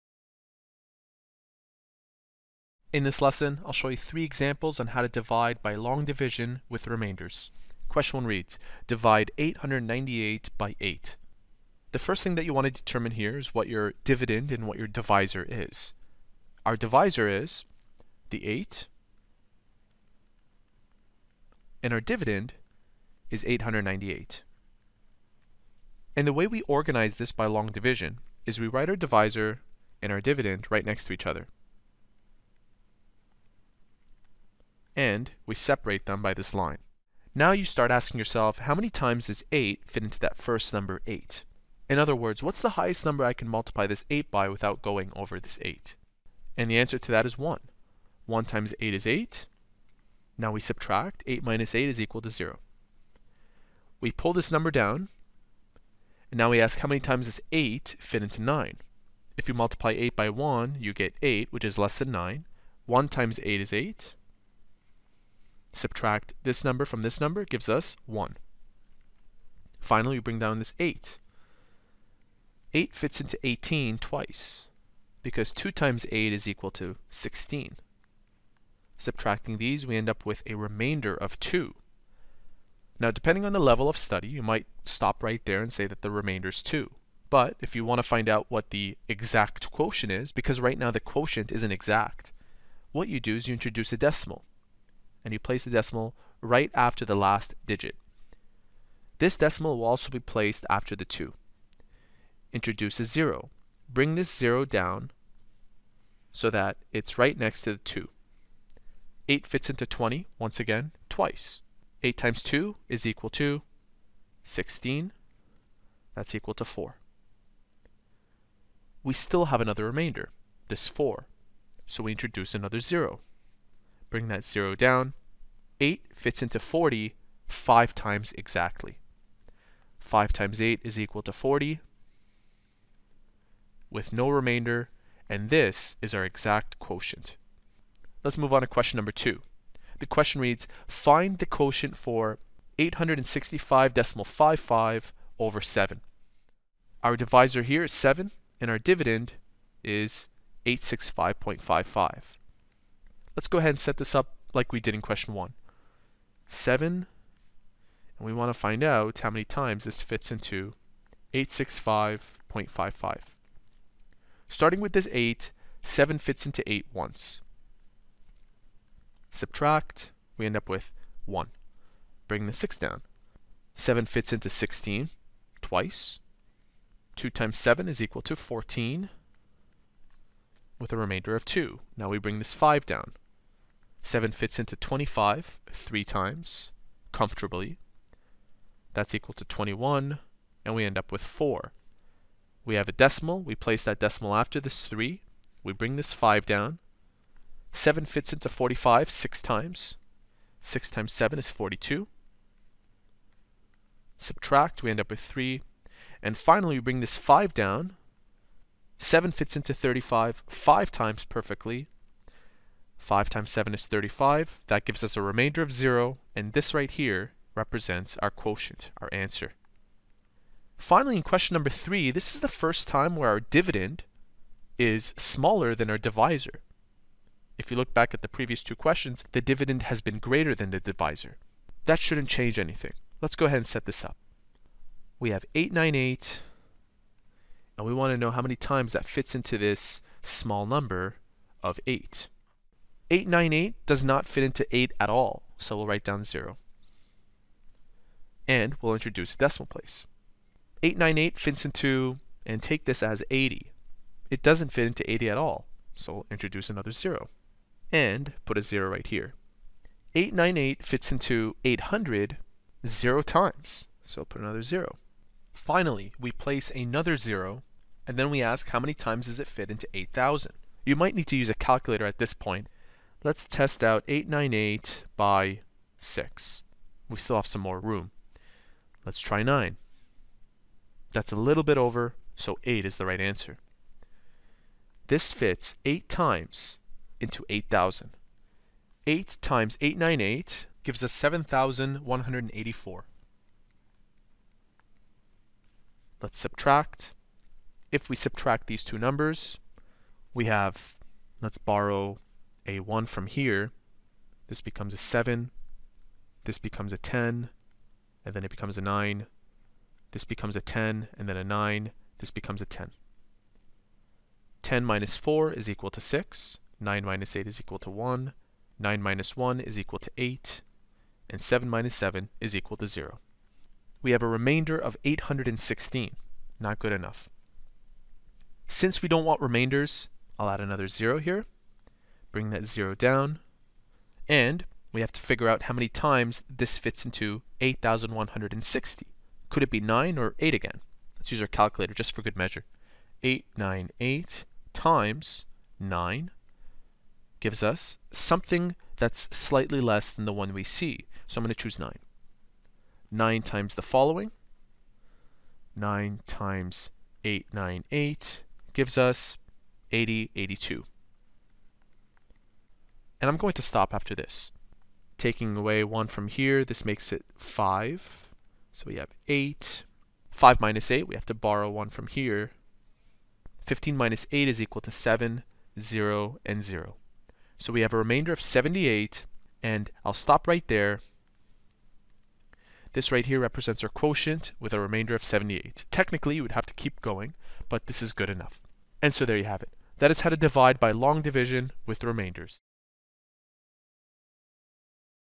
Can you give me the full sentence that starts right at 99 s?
This decimal will also be placed after the 2.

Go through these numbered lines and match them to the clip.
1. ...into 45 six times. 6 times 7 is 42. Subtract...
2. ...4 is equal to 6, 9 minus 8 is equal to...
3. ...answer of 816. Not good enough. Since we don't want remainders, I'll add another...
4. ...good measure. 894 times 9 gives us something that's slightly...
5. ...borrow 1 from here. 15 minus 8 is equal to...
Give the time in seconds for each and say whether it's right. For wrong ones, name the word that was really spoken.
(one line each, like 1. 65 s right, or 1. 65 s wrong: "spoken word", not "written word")
1. 198 s right
2. 315 s right
3. 324 s wrong: "remainder", not "answer"
4. 342 s wrong: "898", not "894"
5. 371 s right.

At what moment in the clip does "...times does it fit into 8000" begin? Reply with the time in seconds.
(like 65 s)
268 s.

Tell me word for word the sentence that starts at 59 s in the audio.
If you multiply 8 by 1, you get 8, which is less than 9.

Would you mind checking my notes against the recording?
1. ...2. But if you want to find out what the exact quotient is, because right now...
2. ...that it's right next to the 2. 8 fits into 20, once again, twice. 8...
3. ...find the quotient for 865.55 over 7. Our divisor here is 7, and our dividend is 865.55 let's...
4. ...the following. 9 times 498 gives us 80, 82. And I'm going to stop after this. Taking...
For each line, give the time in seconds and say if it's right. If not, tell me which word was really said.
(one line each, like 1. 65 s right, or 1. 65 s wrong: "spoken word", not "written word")
1. 86 s right
2. 106 s right
3. 140 s right
4. 353 s wrong: "898", not "498".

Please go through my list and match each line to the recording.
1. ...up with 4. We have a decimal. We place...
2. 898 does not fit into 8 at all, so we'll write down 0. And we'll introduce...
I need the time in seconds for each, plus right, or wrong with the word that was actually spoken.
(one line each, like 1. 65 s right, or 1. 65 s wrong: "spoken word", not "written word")
1. 190 s right
2. 243 s right.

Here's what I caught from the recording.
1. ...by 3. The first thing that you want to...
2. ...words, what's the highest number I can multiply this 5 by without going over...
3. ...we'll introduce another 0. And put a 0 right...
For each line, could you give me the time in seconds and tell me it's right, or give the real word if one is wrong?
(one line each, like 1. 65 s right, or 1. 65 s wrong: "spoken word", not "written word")
1. 10 s wrong: "8", not "3"
2. 42 s wrong: "8", not "5"
3. 256 s right.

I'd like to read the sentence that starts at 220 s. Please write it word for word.
Finally, in question number 3, this is the first time where our dividend is smaller than our divisor.